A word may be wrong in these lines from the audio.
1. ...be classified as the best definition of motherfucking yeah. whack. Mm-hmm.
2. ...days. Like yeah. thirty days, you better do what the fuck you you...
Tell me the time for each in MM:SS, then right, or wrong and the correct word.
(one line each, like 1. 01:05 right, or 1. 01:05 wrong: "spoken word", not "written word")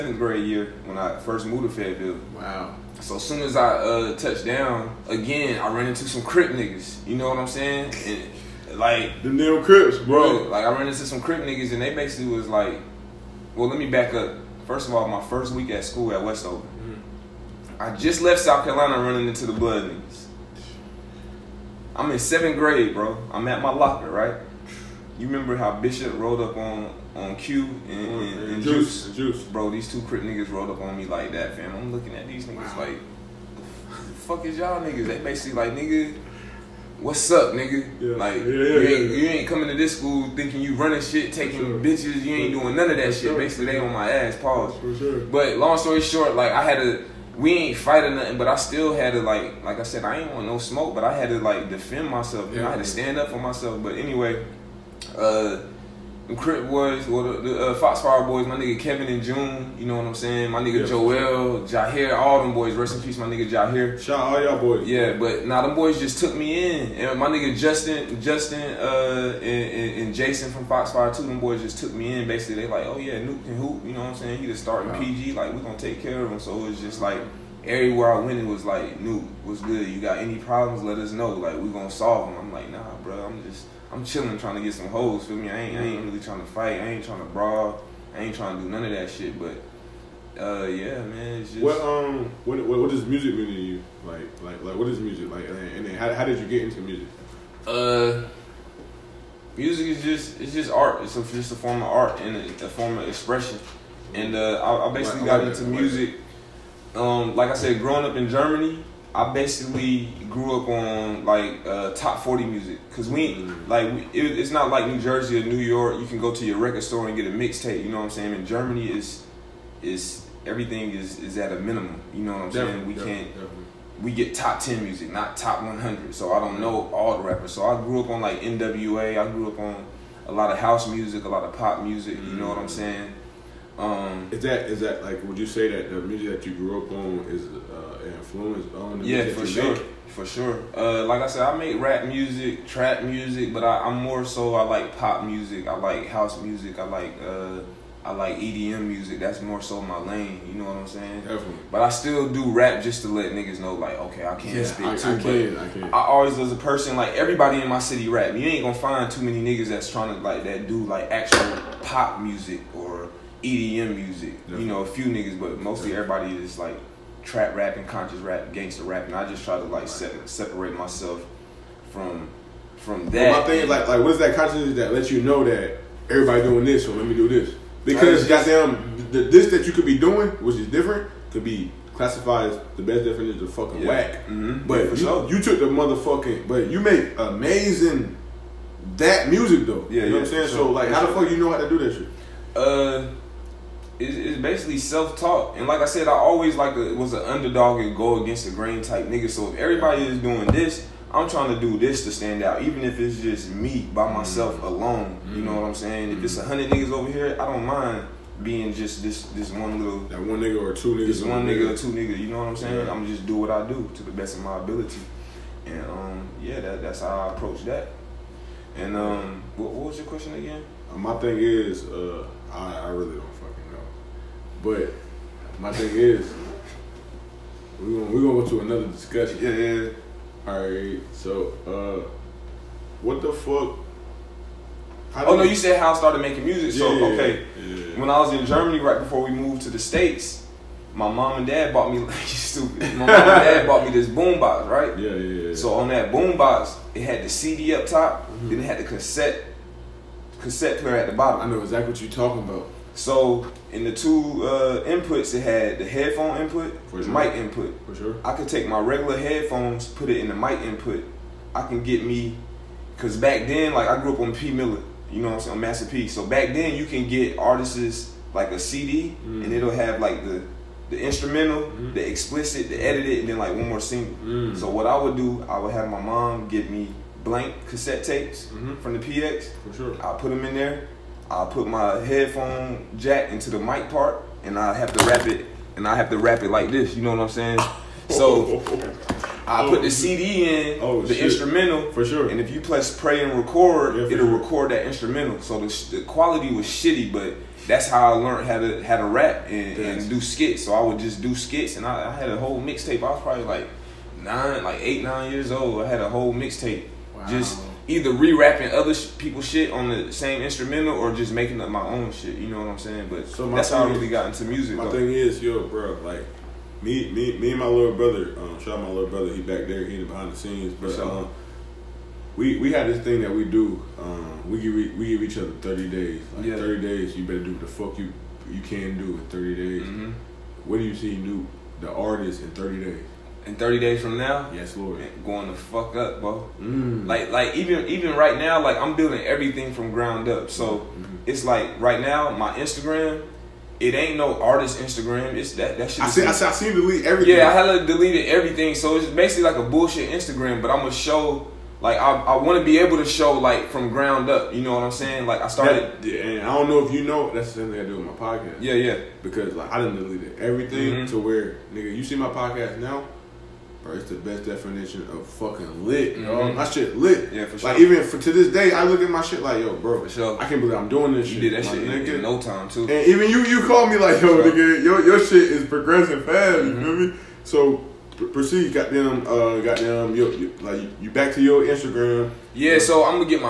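1. 03:01 wrong: "fucking", not "motherfucking"
2. 05:25 right.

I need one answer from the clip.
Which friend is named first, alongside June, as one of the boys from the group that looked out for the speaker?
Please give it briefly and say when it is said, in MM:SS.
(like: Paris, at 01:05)
Kevin, at 00:58.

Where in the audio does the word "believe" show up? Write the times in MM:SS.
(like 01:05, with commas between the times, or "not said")
06:10.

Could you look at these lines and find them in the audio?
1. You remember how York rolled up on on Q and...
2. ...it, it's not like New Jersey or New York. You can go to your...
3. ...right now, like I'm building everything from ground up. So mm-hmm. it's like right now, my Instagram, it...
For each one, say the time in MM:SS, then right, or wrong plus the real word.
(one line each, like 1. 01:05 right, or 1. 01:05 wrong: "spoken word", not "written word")
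1. 00:25 wrong: "Bishop", not "York"
2. 01:54 right
3. 05:38 right.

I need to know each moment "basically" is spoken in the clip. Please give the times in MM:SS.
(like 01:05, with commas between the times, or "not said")
00:11, 00:35, 00:43, 01:12, 01:44, 01:49, 03:14, 05:49.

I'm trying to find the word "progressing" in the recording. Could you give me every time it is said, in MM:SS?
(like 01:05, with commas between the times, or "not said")
06:15.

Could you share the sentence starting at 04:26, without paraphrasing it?
So back then, you can get artists like a CD, mm.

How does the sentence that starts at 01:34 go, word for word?
Like like like what is music like?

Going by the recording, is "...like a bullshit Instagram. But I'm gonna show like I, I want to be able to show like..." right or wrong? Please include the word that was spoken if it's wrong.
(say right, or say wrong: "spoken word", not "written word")
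right.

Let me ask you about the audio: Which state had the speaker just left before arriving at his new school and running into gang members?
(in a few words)
South Carolina.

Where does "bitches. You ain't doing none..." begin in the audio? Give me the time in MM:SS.
00:41.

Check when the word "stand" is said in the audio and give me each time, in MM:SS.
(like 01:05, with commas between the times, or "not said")
00:52, 03:22.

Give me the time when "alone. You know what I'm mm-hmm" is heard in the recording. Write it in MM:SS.
03:24.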